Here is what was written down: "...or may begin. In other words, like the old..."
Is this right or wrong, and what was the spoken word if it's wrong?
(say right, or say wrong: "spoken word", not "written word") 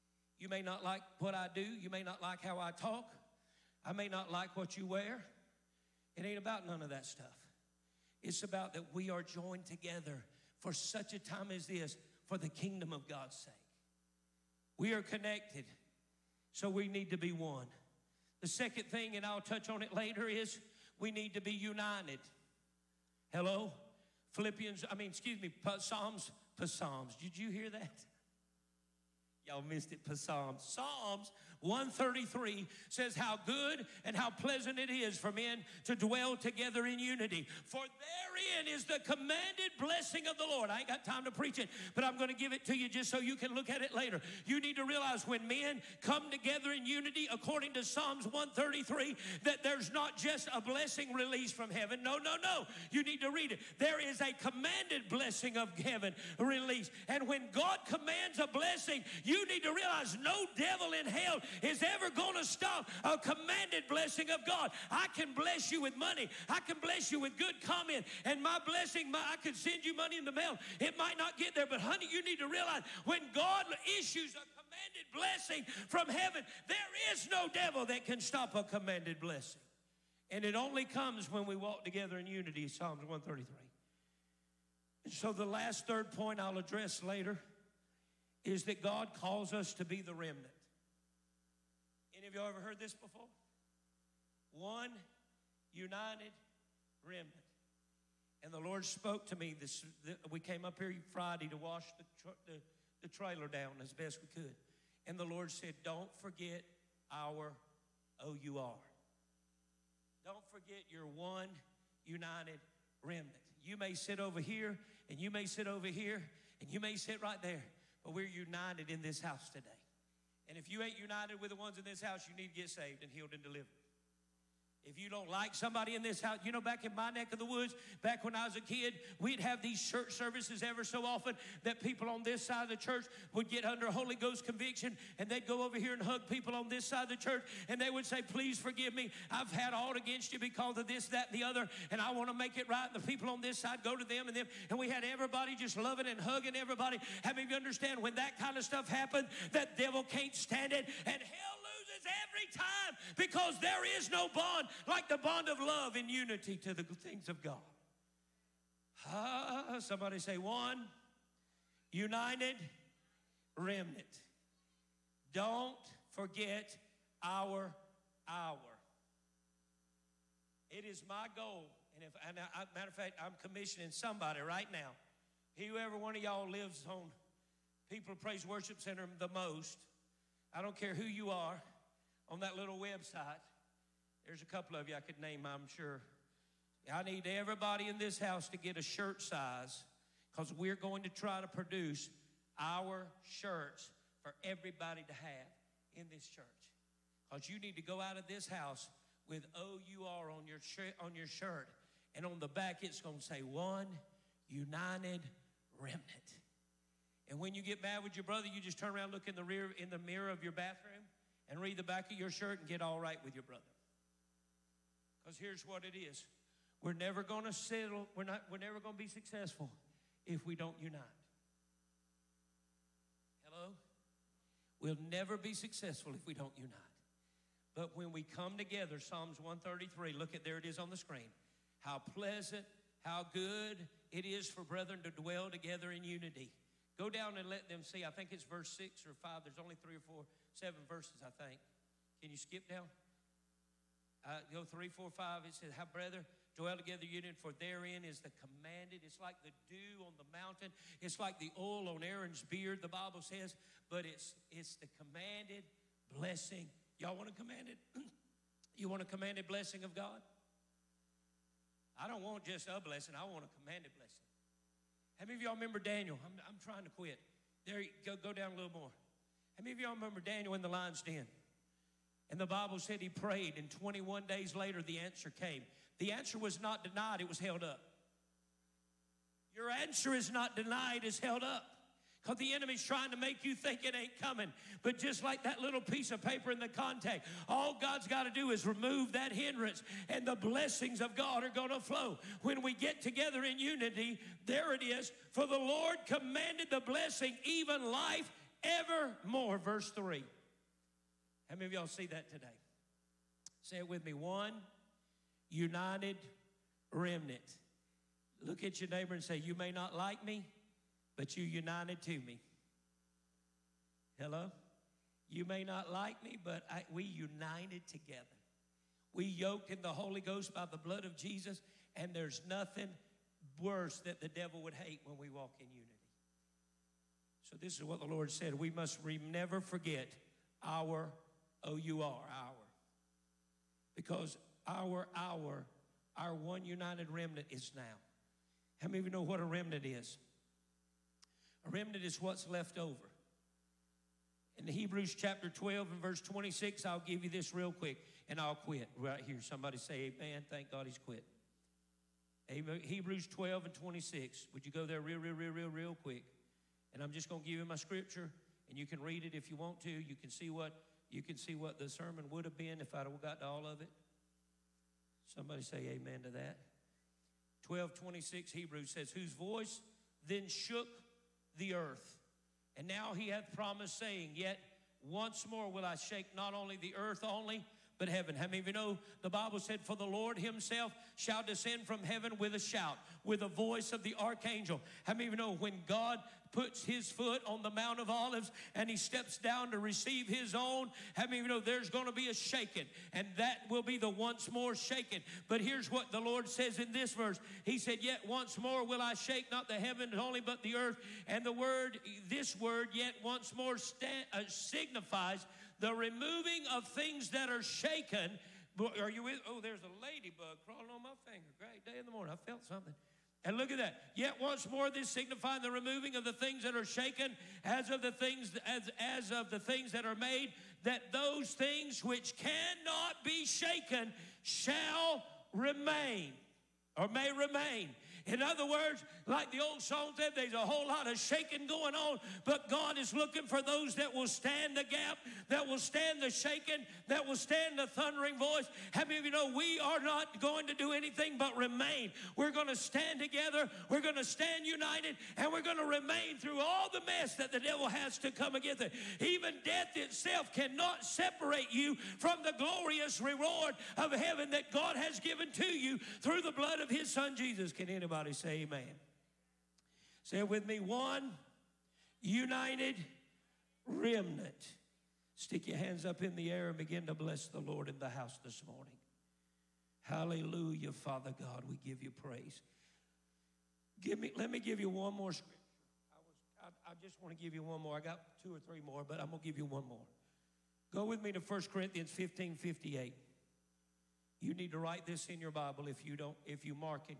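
wrong: "remain", not "begin".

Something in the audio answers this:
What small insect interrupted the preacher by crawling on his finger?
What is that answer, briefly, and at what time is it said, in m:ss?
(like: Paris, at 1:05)
A ladybug, at 6:50.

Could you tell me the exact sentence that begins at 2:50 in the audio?
It is my goal, and if and I, matter of fact, I'm commissioning somebody right now.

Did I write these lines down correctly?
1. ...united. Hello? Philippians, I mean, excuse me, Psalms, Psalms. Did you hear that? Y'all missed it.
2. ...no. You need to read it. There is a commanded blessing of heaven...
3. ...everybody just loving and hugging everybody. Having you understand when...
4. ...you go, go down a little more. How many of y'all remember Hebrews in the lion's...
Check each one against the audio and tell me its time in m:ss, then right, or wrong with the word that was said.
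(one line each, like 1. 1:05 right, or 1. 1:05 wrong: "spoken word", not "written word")
1. 0:21 right
2. 0:52 right
3. 2:25 right
4. 4:27 wrong: "Daniel", not "Hebrews".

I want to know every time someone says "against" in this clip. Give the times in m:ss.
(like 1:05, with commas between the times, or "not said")
2:19, 7:28.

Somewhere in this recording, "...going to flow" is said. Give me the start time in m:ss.
4:51.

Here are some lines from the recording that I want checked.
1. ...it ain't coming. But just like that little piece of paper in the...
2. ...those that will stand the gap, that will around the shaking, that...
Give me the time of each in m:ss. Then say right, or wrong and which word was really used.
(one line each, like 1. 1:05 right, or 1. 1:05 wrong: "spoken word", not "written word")
1. 4:43 right
2. 7:13 wrong: "stand", not "around".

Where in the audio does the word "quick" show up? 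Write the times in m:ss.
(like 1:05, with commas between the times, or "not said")
5:47, 5:56.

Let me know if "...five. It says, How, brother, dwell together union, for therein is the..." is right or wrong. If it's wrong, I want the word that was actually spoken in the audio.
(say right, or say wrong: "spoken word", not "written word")
right.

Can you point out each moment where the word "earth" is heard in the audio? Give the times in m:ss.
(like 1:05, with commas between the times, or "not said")
6:11, 6:16, 6:40.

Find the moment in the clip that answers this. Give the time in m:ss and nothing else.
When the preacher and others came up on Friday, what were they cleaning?
1:43.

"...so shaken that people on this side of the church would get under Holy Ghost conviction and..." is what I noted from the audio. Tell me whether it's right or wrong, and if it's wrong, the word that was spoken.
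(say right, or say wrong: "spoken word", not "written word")
wrong: "often", not "shaken".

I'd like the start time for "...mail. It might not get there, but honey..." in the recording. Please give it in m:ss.
1:10.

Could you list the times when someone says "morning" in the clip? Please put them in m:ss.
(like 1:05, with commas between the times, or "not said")
6:52, 7:48.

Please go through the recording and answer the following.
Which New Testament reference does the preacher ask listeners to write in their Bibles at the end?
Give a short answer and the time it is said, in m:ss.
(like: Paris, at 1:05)
1 Corinthians 15:58, at 8:01.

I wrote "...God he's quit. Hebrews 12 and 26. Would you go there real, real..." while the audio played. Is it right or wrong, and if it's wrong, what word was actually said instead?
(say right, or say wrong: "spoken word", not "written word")
right.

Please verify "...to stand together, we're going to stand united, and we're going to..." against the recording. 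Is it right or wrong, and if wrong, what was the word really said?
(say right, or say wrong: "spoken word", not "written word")
right.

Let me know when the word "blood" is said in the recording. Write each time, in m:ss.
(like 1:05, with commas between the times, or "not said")
5:20, 7:36.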